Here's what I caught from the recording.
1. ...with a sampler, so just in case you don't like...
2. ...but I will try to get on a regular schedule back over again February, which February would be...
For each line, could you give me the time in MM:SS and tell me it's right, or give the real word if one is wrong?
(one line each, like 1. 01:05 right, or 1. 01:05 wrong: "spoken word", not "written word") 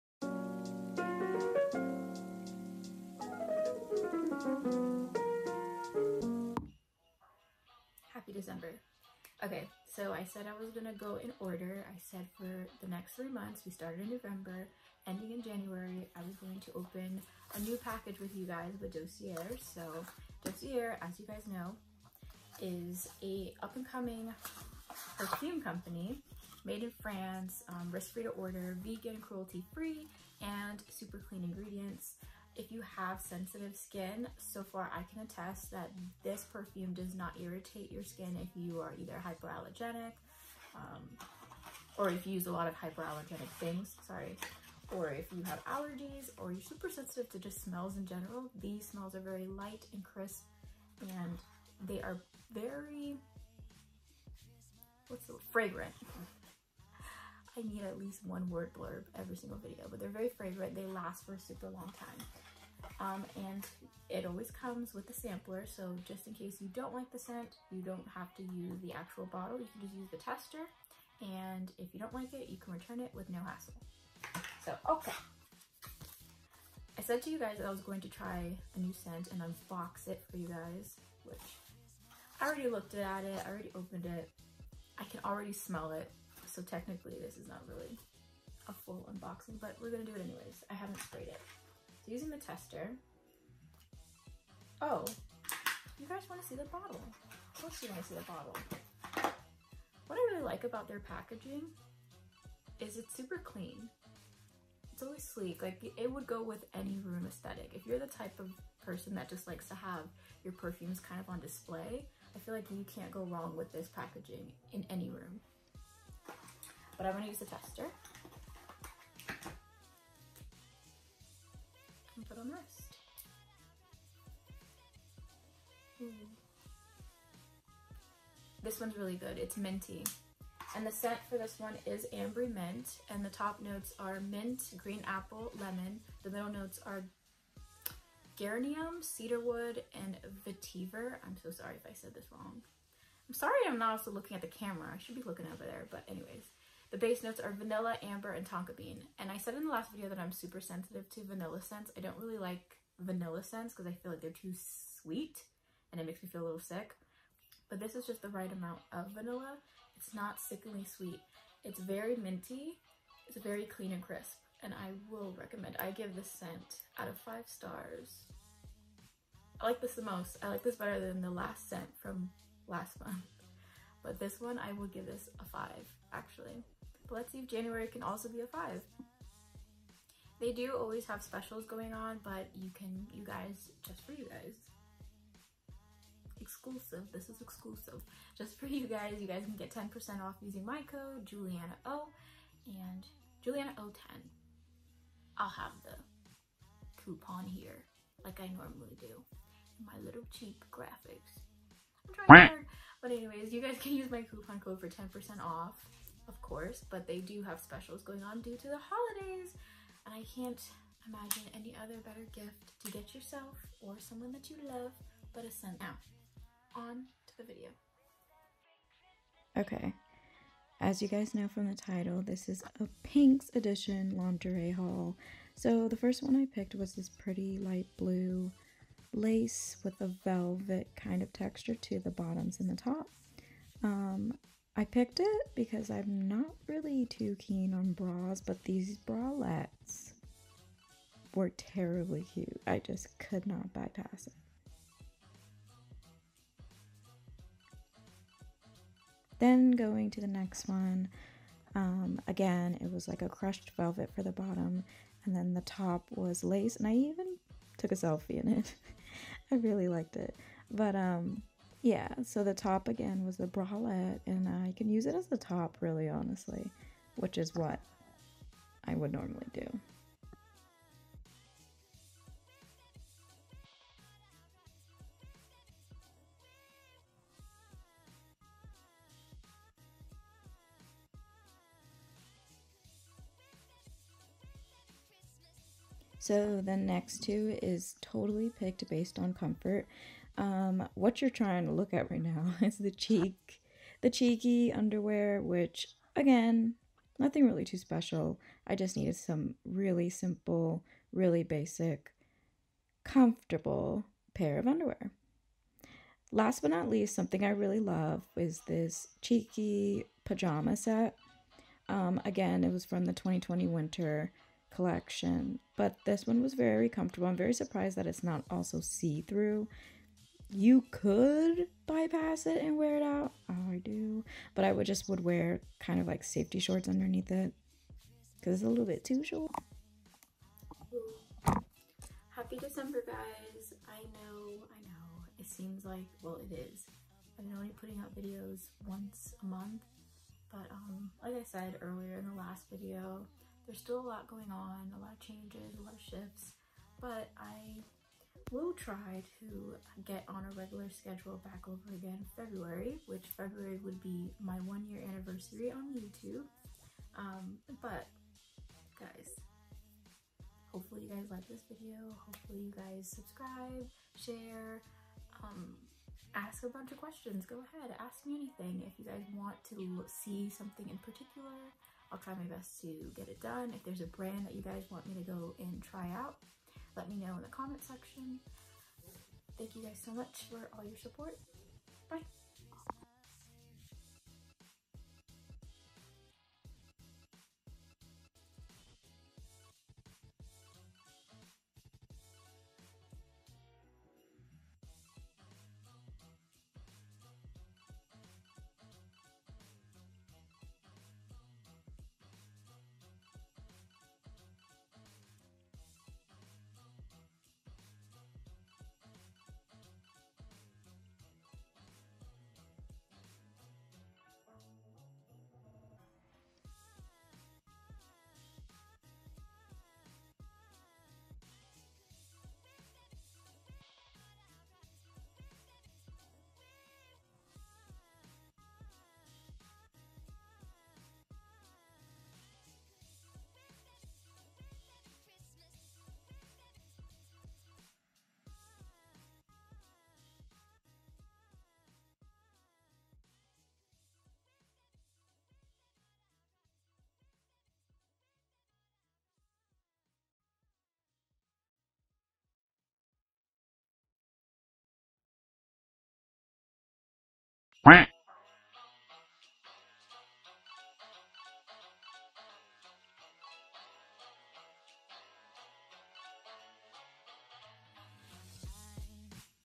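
1. 01:04 right
2. 05:46 right.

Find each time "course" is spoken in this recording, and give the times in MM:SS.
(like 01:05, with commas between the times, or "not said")
01:37, 03:26.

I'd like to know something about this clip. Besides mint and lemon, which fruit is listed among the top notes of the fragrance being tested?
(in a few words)
Green apple.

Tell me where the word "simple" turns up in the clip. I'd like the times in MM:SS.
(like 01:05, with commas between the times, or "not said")
05:00.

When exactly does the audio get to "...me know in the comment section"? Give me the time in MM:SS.
06:17.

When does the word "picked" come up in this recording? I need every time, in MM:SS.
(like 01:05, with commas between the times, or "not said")
03:46, 03:54, 04:48.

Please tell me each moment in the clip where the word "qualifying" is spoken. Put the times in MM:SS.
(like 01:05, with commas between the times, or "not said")
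not said.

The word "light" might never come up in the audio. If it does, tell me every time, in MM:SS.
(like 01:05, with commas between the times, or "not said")
00:49, 03:47.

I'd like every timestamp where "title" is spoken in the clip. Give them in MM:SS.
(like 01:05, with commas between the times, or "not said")
03:41.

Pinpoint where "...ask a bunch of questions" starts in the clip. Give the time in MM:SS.
06:06.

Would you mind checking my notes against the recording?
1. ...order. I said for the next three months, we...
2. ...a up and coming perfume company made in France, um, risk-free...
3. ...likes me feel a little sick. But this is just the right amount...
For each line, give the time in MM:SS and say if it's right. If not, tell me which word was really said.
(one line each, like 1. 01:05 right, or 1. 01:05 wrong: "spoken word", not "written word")
1. 00:11 right
2. 00:23 right
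3. 02:36 wrong: "makes", not "likes".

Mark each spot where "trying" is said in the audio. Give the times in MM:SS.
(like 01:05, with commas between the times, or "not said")
03:22, 04:51.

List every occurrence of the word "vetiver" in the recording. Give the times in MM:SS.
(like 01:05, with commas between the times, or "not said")
02:20.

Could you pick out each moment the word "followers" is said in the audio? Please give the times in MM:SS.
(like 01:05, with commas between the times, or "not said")
not said.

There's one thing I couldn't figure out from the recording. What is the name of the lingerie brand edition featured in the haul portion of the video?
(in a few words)
Pink.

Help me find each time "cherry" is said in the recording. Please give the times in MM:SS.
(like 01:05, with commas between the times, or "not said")
not said.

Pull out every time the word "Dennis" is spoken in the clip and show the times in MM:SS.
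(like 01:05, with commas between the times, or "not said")
not said.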